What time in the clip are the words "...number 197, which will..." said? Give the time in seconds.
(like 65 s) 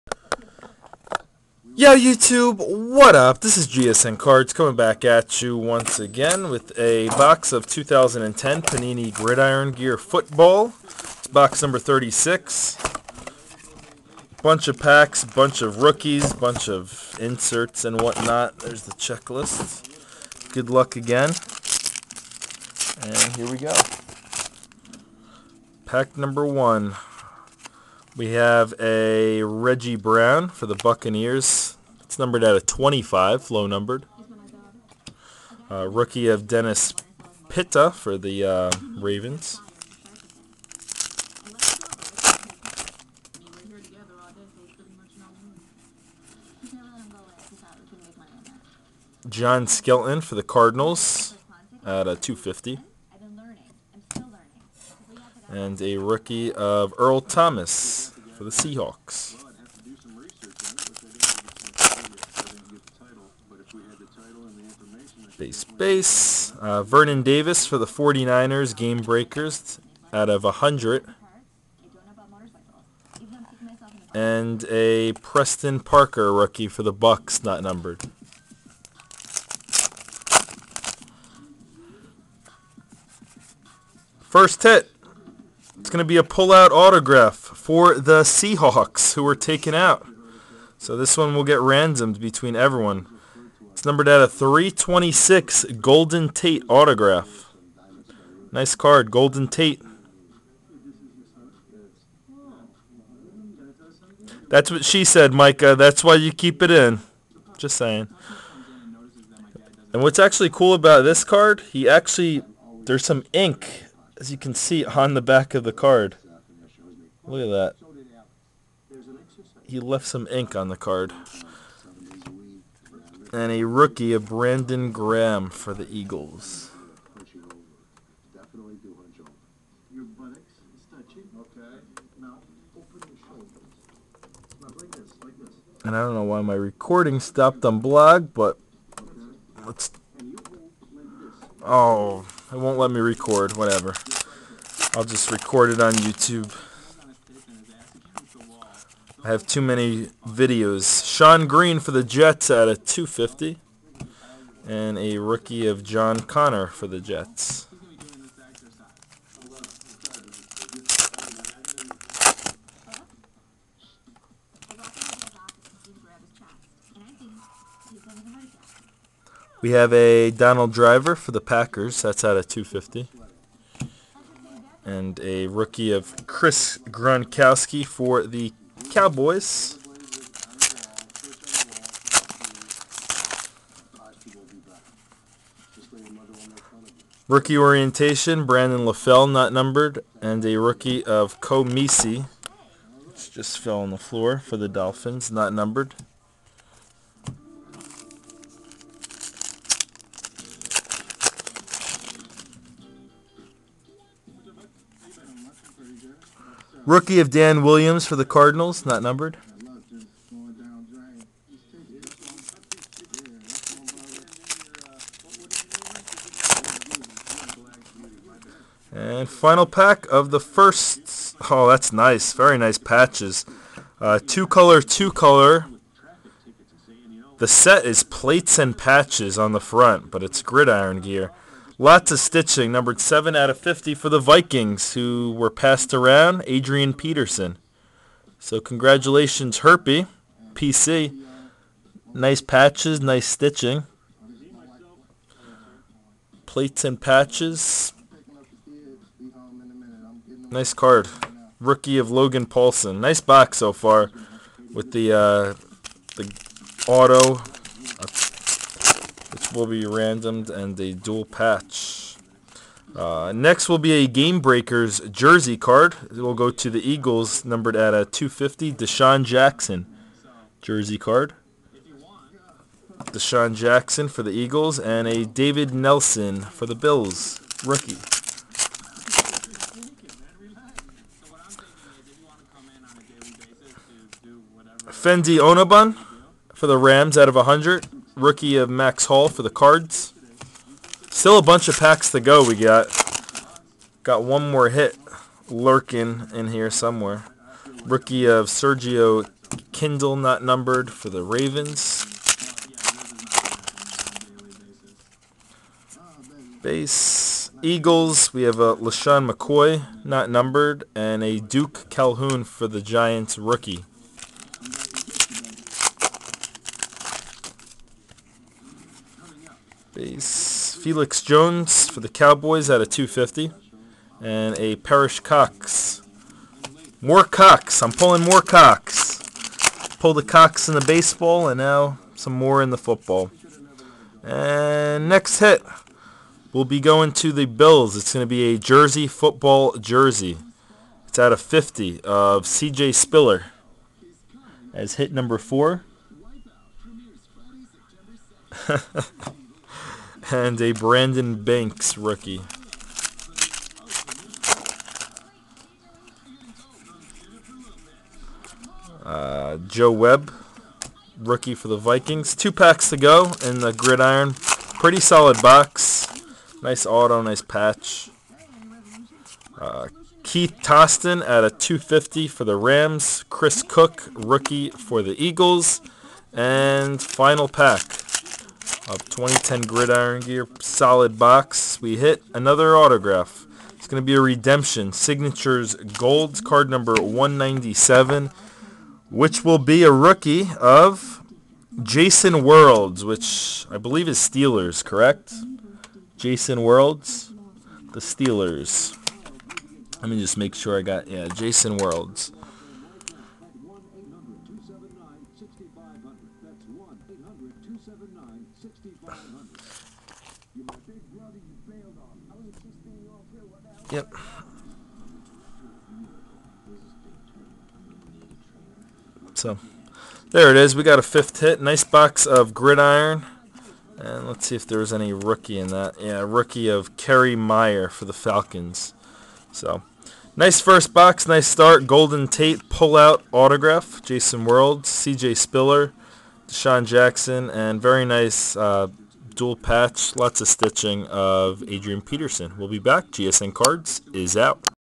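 386 s.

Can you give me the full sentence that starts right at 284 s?
Fendi Onobun for the Rams out of 100 rookie of Max Hall for the Cards.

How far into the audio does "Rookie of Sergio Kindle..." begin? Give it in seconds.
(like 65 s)
297 s.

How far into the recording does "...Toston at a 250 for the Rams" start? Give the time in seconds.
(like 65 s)
370 s.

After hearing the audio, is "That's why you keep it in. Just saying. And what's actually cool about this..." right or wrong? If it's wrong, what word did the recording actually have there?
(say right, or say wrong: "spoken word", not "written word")
right.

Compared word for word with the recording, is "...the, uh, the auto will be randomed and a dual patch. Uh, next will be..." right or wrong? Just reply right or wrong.
right.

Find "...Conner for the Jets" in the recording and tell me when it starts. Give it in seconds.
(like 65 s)
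156 s.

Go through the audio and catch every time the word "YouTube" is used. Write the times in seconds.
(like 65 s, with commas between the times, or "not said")
1 s, 145 s.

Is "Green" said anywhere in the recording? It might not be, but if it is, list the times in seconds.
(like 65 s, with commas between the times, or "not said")
151 s.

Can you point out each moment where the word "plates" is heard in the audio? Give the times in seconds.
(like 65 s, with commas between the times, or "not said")
228 s, 246 s.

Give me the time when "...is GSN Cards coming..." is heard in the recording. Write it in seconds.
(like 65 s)
3 s.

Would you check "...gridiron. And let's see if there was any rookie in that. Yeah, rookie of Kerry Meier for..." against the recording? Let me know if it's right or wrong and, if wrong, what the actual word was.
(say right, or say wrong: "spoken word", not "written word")
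right.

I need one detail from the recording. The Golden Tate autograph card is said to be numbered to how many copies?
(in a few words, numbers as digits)
326.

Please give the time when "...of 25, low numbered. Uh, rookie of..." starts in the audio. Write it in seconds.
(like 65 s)
32 s.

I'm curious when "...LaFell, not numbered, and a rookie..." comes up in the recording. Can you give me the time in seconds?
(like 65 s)
188 s.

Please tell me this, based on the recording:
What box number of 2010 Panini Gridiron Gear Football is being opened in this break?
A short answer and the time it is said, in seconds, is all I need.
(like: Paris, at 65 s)
36, at 11 s.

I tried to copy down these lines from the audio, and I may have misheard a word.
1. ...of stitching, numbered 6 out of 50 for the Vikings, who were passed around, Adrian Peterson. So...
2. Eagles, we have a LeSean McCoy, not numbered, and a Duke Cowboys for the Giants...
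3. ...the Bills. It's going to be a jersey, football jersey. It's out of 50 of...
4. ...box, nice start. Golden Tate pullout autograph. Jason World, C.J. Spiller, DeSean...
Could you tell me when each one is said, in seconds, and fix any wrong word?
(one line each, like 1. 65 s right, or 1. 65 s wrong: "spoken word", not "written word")
1. 232 s wrong: "7", not "6"
2. 307 s wrong: "Calhoun", not "Cowboys"
3. 337 s right
4. 430 s right.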